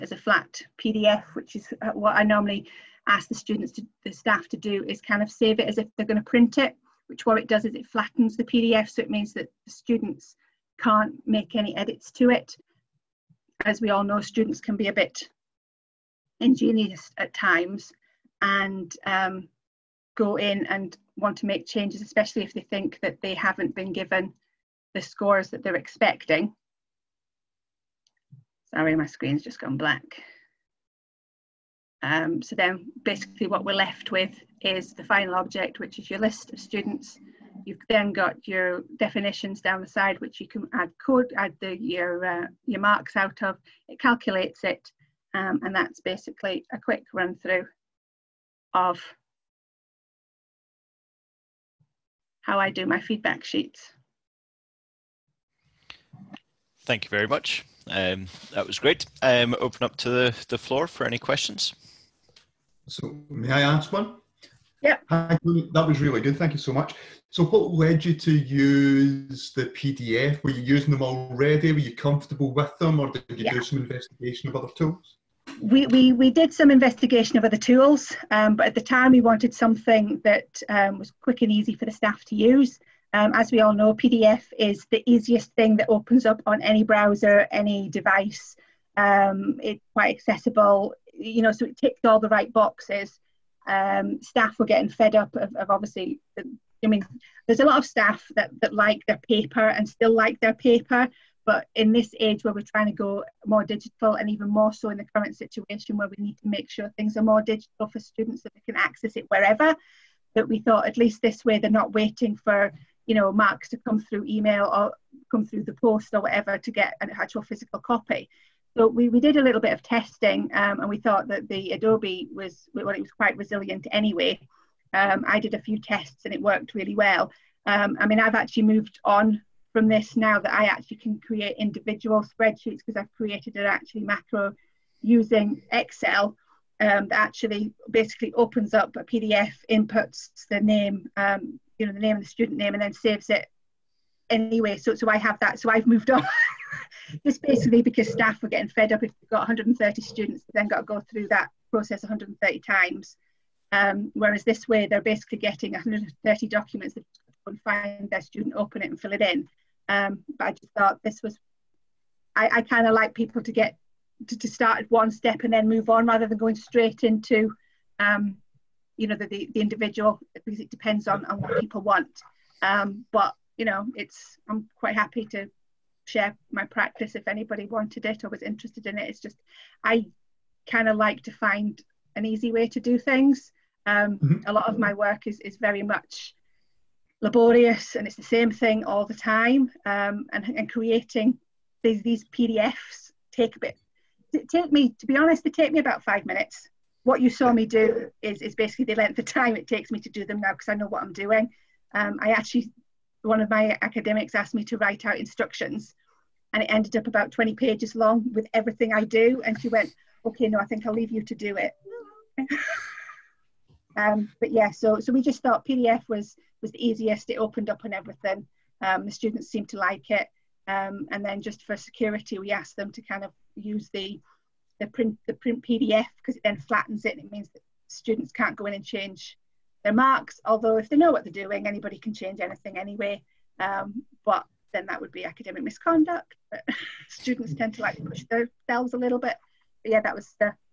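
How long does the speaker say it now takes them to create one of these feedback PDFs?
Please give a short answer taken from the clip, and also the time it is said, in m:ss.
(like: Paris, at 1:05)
5 minutes, at 3:16.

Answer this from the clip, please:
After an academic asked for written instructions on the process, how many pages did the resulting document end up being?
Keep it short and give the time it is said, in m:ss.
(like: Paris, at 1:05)
20 pages, at 3:27.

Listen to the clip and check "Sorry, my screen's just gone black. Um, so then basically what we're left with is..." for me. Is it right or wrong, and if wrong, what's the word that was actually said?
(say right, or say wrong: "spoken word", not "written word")
right.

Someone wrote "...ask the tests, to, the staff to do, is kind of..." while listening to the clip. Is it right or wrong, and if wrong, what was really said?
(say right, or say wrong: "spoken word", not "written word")
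wrong: "students", not "tests".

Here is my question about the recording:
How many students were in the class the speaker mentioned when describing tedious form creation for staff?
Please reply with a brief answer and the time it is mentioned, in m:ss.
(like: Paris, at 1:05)
130, at 2:29.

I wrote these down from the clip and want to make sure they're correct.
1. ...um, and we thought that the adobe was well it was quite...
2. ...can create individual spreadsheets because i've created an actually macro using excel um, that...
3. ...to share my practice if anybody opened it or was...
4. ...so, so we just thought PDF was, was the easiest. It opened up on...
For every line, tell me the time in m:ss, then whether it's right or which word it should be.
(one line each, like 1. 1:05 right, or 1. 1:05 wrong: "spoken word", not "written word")
1. 2:00 right
2. 2:10 right
3. 2:55 wrong: "wanted", not "opened"
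4. 3:34 right.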